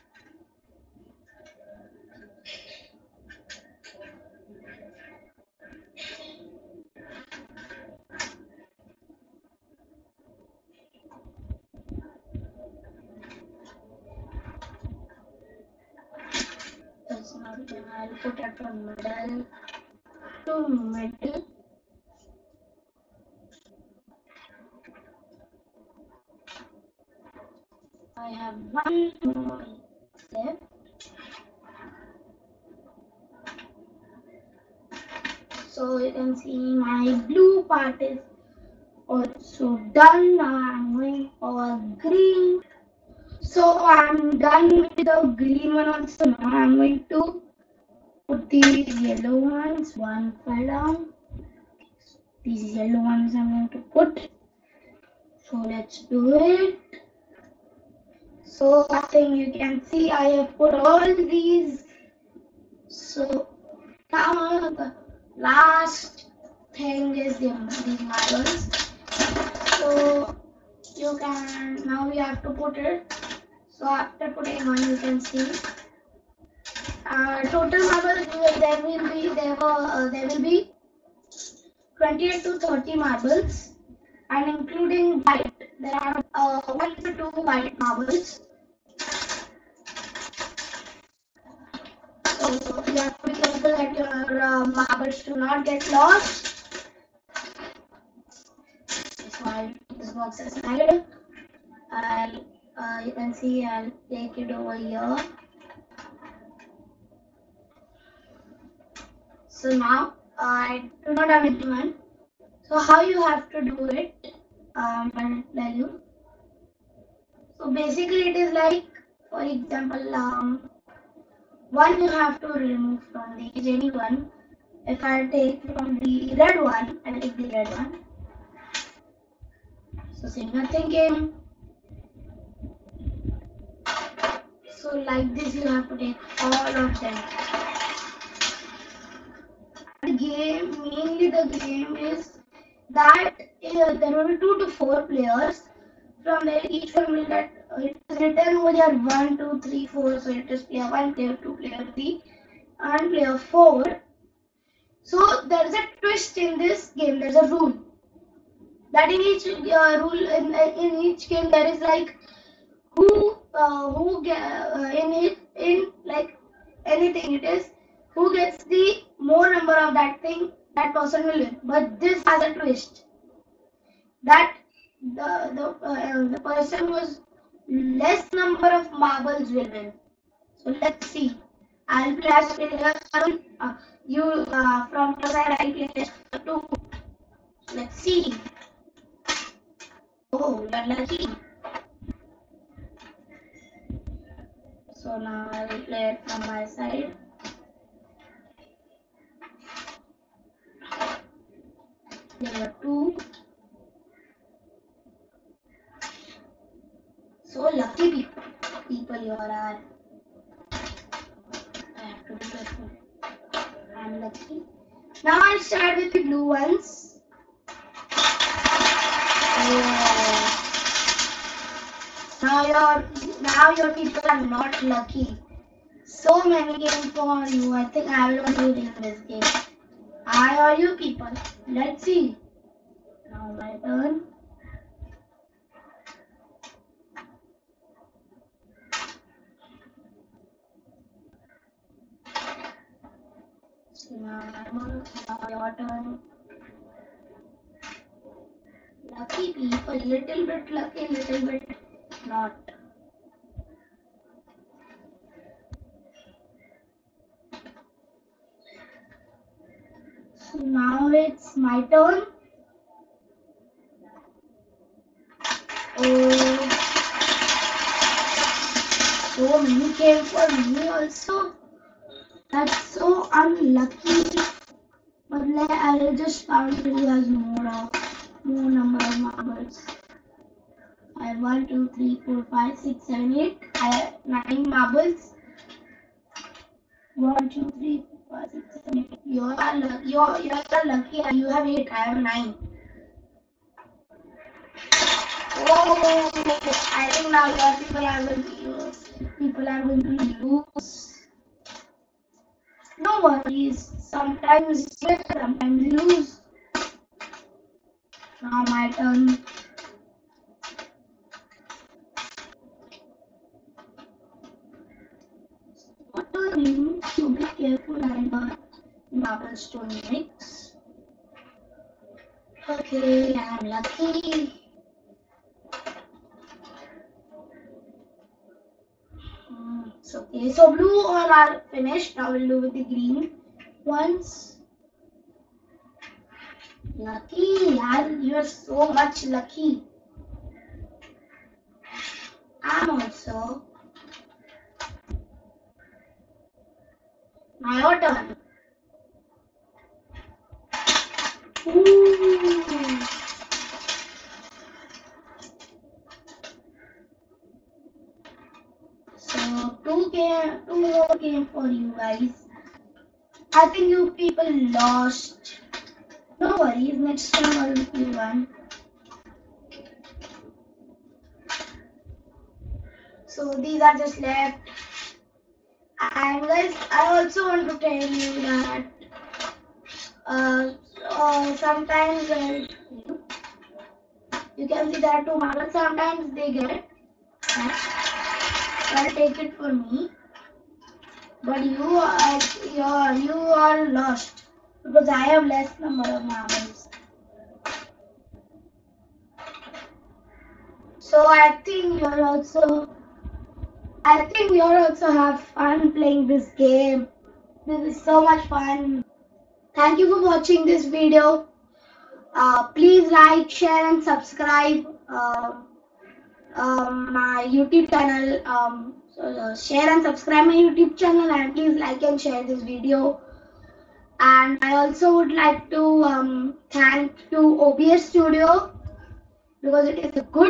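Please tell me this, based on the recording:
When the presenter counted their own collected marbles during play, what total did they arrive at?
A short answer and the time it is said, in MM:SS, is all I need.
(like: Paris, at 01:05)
9, at 04:43.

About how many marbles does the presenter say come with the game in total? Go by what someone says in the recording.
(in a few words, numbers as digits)
28 to 30.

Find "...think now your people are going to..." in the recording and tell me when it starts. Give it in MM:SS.
04:57.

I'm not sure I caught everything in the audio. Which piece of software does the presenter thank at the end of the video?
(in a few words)
OBS Studio.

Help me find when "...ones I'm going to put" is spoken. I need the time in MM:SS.
00:53.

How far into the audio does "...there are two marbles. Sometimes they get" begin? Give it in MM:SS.
06:25.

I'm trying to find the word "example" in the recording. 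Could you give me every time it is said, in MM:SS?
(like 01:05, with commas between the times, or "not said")
01:59.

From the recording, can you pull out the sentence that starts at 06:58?
Um, so, uh, share and subscribe my YouTube channel and please like and share this video.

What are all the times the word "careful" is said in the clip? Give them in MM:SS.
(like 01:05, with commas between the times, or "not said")
01:33, 03:32.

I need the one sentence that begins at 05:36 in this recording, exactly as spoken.
Lucky, and you're so much lucky.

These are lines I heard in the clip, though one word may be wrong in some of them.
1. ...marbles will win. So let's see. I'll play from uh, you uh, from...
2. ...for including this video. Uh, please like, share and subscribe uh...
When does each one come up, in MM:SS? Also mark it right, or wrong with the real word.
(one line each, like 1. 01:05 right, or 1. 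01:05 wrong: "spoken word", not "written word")
1. 02:58 right
2. 06:50 wrong: "watching", not "including".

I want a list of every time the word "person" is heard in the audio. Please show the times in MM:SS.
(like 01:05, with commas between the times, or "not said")
02:50, 02:56.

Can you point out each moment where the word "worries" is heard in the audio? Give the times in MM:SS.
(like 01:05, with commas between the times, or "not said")
05:03, 06:06.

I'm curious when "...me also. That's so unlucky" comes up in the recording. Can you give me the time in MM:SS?
04:30.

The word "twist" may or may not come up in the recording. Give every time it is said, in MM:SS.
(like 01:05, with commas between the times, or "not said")
02:35, 02:52.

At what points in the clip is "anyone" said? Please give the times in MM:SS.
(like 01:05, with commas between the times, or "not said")
01:51, 02:03.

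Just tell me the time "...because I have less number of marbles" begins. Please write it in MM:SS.
06:34.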